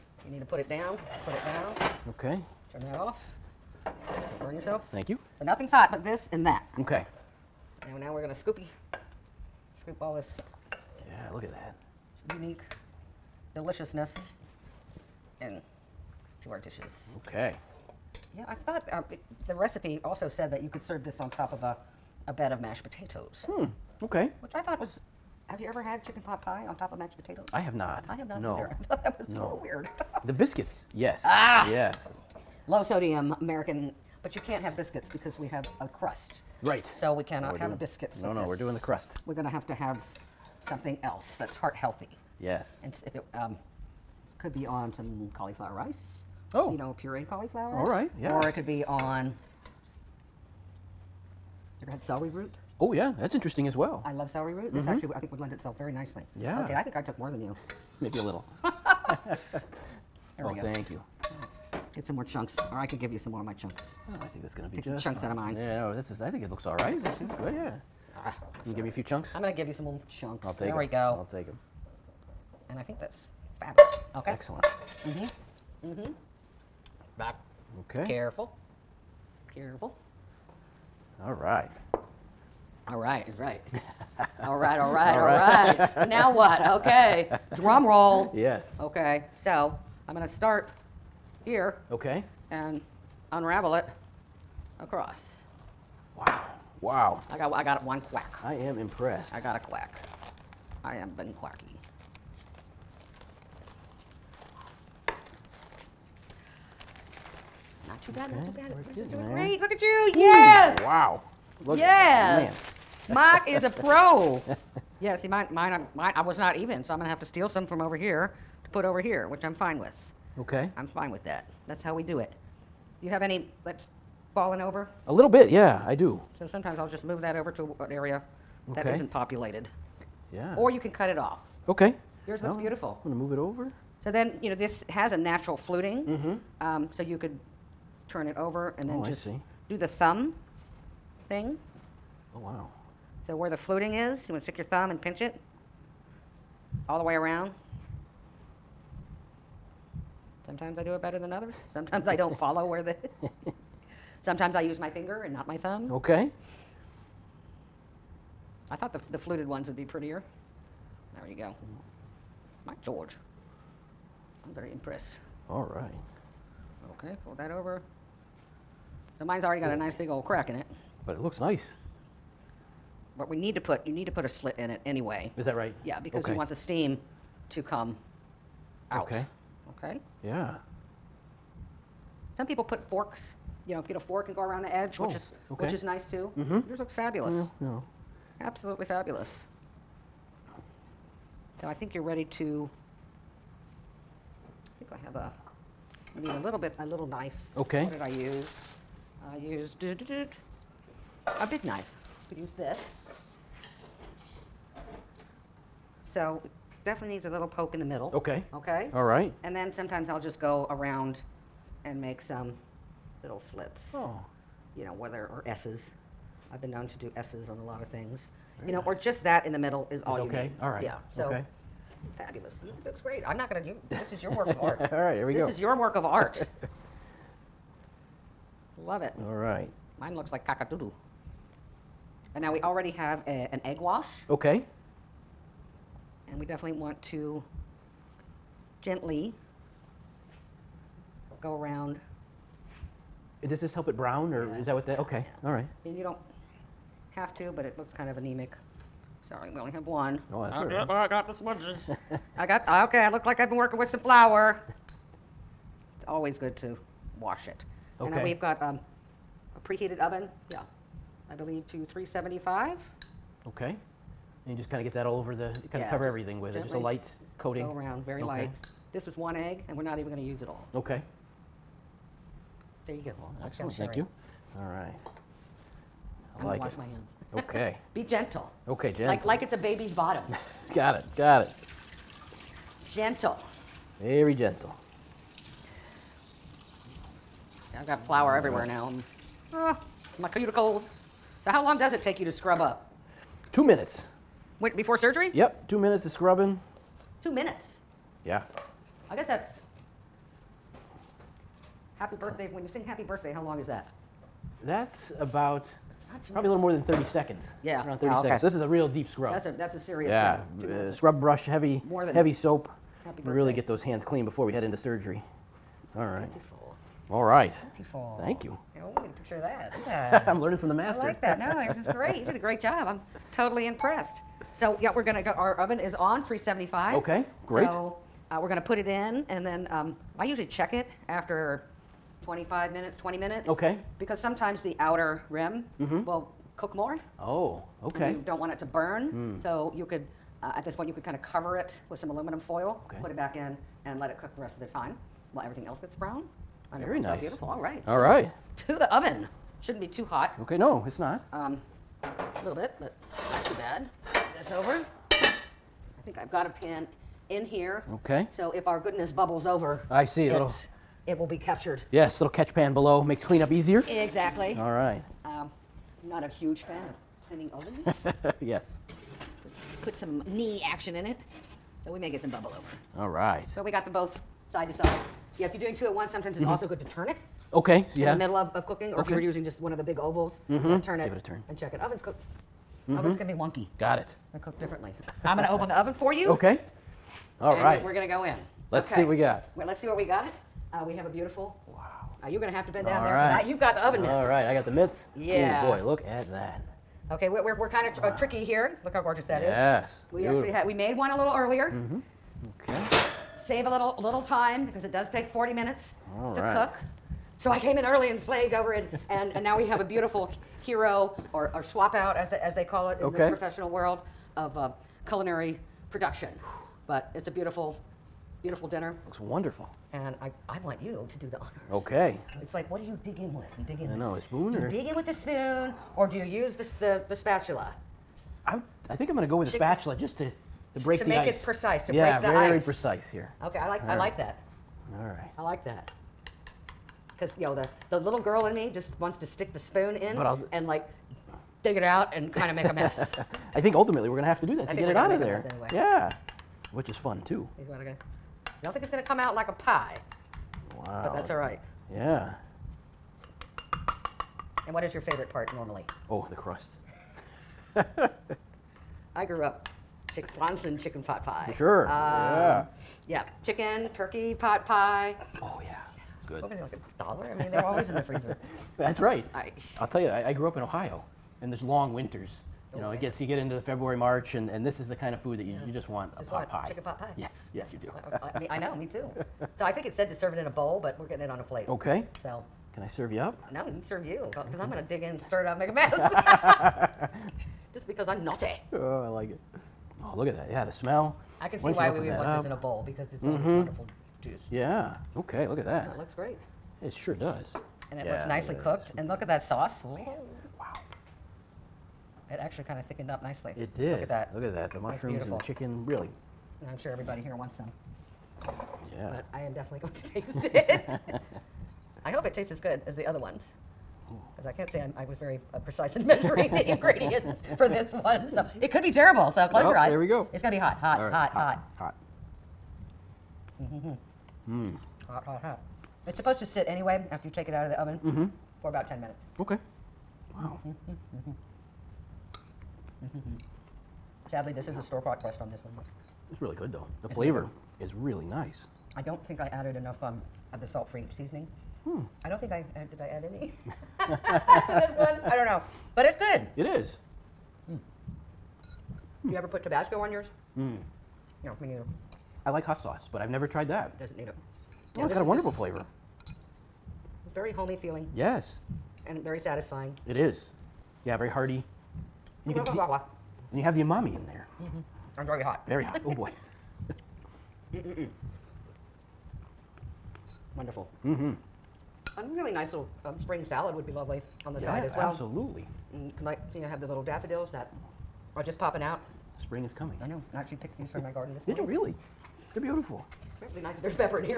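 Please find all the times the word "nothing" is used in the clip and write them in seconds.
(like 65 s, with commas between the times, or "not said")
5 s.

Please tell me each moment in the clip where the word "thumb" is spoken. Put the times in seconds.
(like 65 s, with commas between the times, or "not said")
139 s, 144 s, 155 s.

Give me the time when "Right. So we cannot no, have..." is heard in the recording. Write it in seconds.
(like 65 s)
36 s.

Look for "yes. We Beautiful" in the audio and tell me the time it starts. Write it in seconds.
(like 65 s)
399 s.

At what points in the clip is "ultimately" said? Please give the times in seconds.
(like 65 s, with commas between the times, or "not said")
443 s.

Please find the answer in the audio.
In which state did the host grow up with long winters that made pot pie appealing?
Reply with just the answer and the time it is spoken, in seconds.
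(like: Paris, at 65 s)
Ohio, at 470 s.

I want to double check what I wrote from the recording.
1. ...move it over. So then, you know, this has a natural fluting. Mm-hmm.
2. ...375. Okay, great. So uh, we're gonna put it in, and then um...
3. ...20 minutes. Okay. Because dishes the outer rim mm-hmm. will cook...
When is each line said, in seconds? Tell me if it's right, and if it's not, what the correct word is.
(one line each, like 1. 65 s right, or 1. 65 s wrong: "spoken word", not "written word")
1. 133 s right
2. 326 s right
3. 332 s wrong: "sometimes", not "dishes".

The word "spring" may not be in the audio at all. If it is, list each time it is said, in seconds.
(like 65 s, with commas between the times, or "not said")
573 s, 579 s.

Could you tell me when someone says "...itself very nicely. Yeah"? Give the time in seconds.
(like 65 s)
55 s.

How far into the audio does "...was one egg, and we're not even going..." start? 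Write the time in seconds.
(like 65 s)
269 s.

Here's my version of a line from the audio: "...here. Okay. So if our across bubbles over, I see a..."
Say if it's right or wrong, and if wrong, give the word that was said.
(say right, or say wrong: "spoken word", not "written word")
wrong: "goodness", not "across".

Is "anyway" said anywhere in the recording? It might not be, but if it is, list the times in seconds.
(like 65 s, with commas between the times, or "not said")
174 s, 445 s, 526 s.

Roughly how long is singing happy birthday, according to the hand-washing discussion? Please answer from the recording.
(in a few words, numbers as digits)
30 seconds.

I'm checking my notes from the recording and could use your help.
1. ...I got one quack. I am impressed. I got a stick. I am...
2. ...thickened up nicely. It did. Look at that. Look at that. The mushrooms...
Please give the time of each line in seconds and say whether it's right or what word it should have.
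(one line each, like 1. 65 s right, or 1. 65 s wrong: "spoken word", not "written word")
1. 97 s wrong: "quack", not "stick"
2. 502 s right.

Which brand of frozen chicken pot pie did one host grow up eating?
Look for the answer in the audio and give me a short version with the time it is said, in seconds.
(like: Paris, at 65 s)
Swanson, at 460 s.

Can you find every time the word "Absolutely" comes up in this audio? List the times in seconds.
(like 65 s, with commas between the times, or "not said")
188 s, 575 s.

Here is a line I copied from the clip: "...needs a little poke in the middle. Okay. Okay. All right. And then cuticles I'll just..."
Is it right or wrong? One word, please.
wrong.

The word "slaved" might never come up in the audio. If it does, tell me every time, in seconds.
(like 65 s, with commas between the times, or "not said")
408 s.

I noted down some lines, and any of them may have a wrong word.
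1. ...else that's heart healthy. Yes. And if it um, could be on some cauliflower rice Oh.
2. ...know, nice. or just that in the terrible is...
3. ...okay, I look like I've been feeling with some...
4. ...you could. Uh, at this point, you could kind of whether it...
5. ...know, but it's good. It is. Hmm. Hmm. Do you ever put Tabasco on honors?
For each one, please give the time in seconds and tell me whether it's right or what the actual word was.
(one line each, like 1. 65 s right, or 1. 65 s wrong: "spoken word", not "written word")
1. 41 s right
2. 218 s wrong: "middle", not "terrible"
3. 252 s wrong: "working", not "feeling"
4. 339 s wrong: "cover", not "whether"
5. 545 s wrong: "yours", not "honors".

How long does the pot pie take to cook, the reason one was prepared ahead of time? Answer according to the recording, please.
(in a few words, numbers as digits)
40 minutes.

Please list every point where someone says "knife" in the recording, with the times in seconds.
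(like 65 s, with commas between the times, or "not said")
197 s, 201 s.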